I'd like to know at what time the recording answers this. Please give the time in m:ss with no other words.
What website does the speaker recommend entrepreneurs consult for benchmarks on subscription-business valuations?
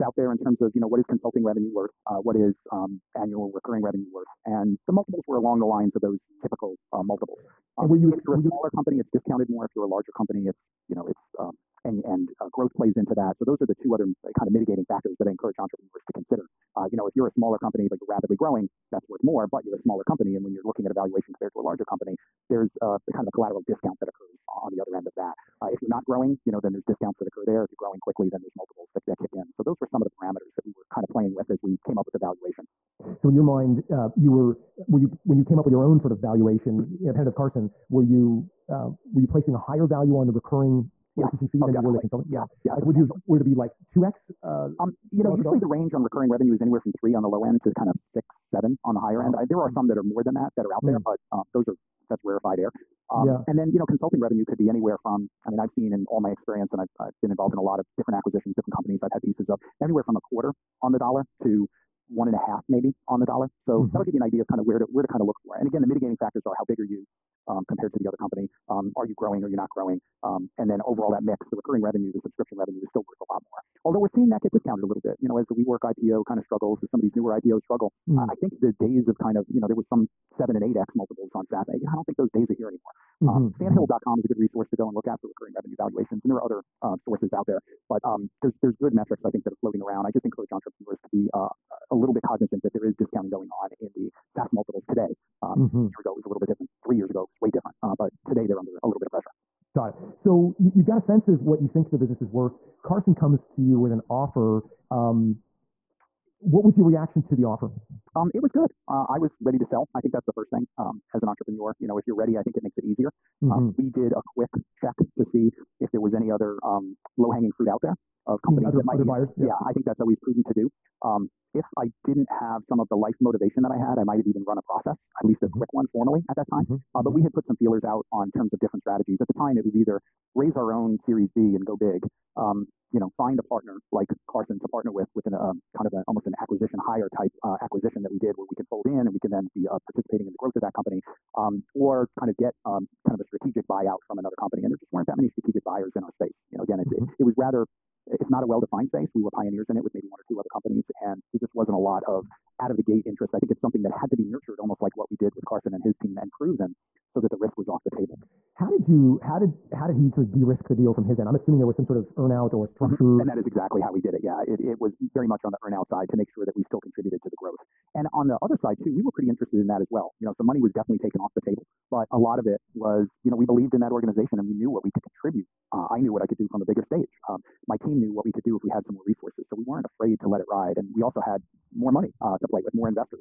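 1:23.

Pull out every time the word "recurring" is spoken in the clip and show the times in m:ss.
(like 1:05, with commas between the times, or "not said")
0:03, 0:40, 0:46, 1:11, 1:25.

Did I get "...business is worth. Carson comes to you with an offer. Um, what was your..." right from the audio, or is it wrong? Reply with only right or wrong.
right.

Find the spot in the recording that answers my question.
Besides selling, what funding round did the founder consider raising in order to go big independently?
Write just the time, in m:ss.
2:10.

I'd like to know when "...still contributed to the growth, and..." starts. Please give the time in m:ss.
2:46.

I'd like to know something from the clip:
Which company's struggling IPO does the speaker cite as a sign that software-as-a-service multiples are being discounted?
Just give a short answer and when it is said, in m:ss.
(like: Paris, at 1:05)
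WeWork, at 1:15.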